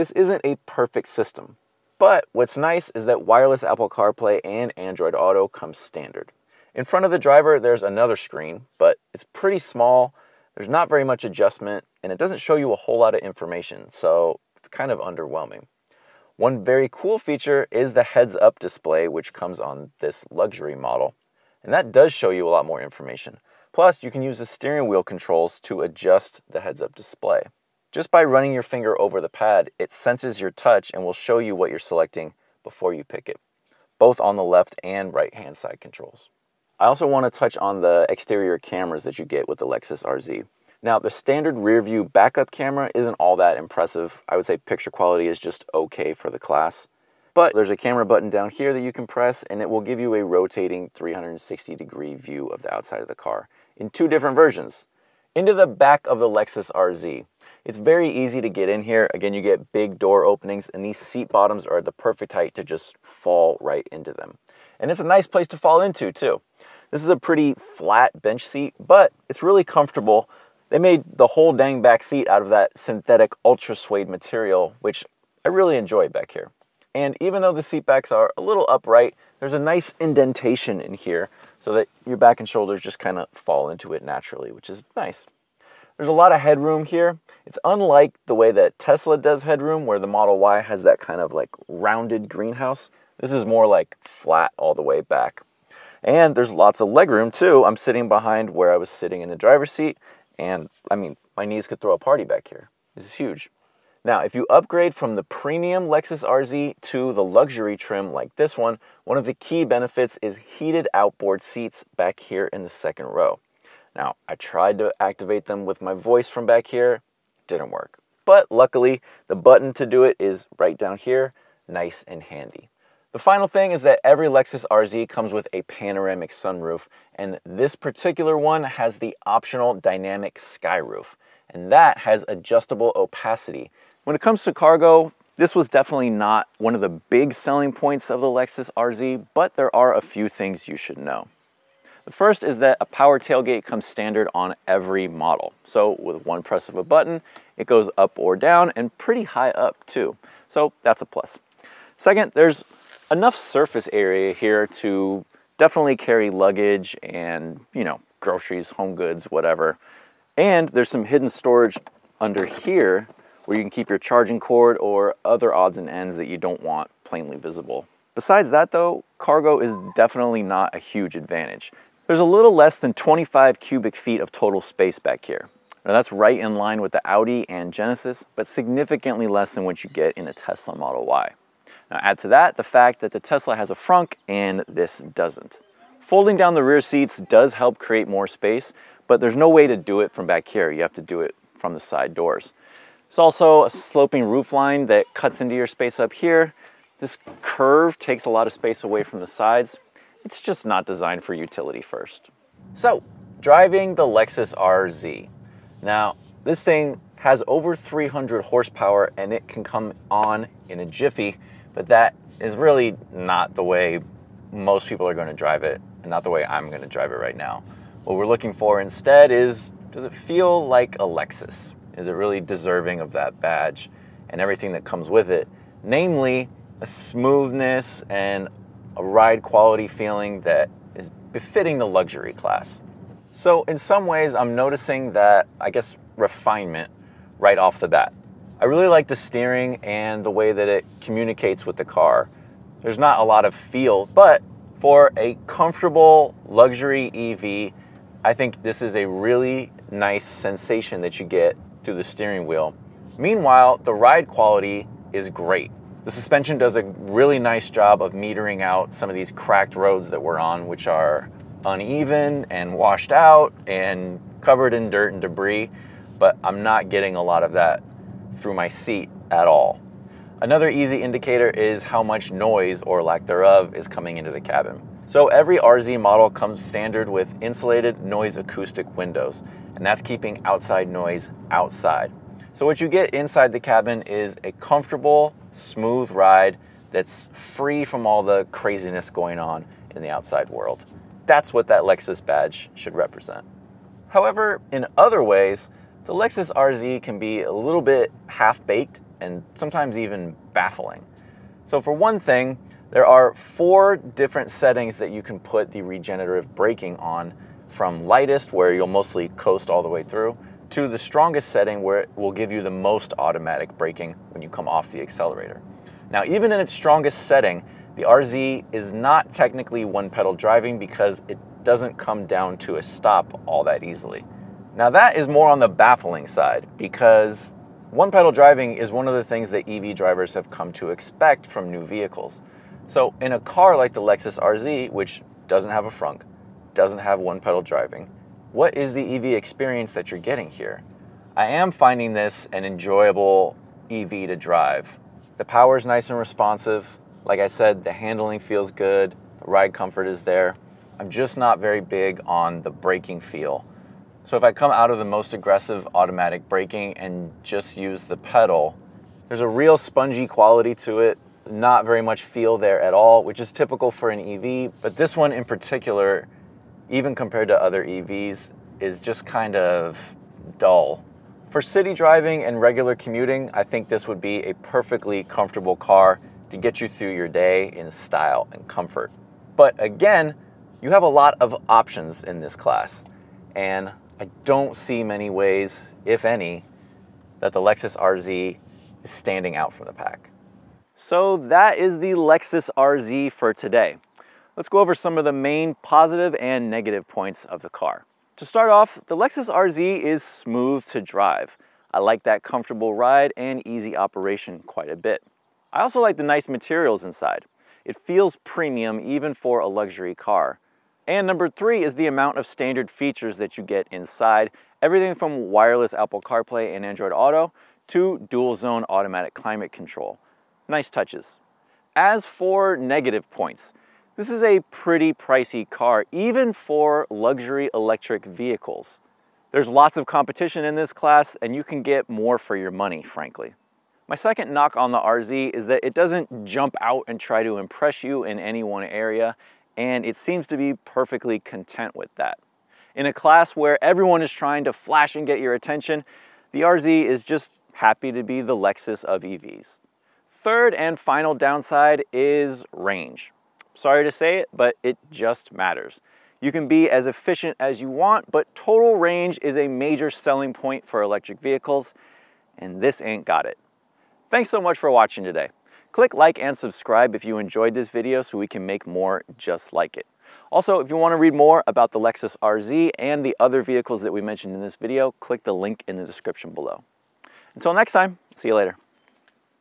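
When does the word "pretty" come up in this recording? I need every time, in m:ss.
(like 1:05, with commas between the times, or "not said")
0:09, 1:07, 2:28, 7:04.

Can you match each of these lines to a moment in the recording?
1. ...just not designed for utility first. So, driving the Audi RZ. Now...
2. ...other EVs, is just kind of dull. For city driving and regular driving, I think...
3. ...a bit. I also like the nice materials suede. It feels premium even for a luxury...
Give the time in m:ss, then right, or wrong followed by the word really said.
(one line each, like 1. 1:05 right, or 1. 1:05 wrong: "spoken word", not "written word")
1. 3:20 wrong: "Lexus", not "Audi"
2. 6:07 wrong: "commuting", not "driving"
3. 6:44 wrong: "inside", not "suede".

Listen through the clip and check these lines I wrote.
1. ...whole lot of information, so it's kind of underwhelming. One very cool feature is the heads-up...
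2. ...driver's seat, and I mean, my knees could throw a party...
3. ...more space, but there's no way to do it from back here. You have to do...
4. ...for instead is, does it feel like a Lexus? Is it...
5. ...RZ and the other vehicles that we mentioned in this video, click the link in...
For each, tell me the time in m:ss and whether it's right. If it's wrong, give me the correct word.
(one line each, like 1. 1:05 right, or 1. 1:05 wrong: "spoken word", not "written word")
1. 0:12 right
2. 1:39 right
3. 3:08 right
4. 3:38 right
5. 7:52 right.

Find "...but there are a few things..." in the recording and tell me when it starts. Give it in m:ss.
2:19.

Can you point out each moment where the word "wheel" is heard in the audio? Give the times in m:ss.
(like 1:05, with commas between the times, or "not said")
0:24, 4:12.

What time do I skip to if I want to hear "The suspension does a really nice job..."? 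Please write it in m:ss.
4:16.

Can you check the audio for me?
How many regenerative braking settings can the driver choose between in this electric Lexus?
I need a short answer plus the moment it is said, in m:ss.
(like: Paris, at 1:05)
4, at 5:03.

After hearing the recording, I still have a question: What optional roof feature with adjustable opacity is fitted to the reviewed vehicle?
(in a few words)
Dynamic sky roof.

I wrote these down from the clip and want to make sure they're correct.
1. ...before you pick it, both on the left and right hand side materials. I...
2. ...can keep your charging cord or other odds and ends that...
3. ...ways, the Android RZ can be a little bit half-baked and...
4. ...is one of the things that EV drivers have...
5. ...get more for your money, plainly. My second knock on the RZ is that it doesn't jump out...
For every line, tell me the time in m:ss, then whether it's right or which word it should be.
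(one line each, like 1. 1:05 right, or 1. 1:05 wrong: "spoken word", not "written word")
1. 0:32 wrong: "controls", not "materials"
2. 2:43 right
3. 4:55 wrong: "Lexus", not "Android"
4. 5:28 right
5. 7:11 wrong: "frankly", not "plainly".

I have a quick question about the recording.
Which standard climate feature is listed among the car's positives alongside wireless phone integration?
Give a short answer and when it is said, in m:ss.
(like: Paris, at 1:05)
Dual zone automatic climate control, at 6:58.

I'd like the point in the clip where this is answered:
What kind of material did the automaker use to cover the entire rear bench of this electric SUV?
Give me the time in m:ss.
1:12.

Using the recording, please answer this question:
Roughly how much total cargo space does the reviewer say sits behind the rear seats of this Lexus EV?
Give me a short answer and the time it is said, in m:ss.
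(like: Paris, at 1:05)
Less than 25 cubic feet, at 2:52.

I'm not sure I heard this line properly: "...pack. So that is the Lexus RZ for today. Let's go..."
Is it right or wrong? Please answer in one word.
right.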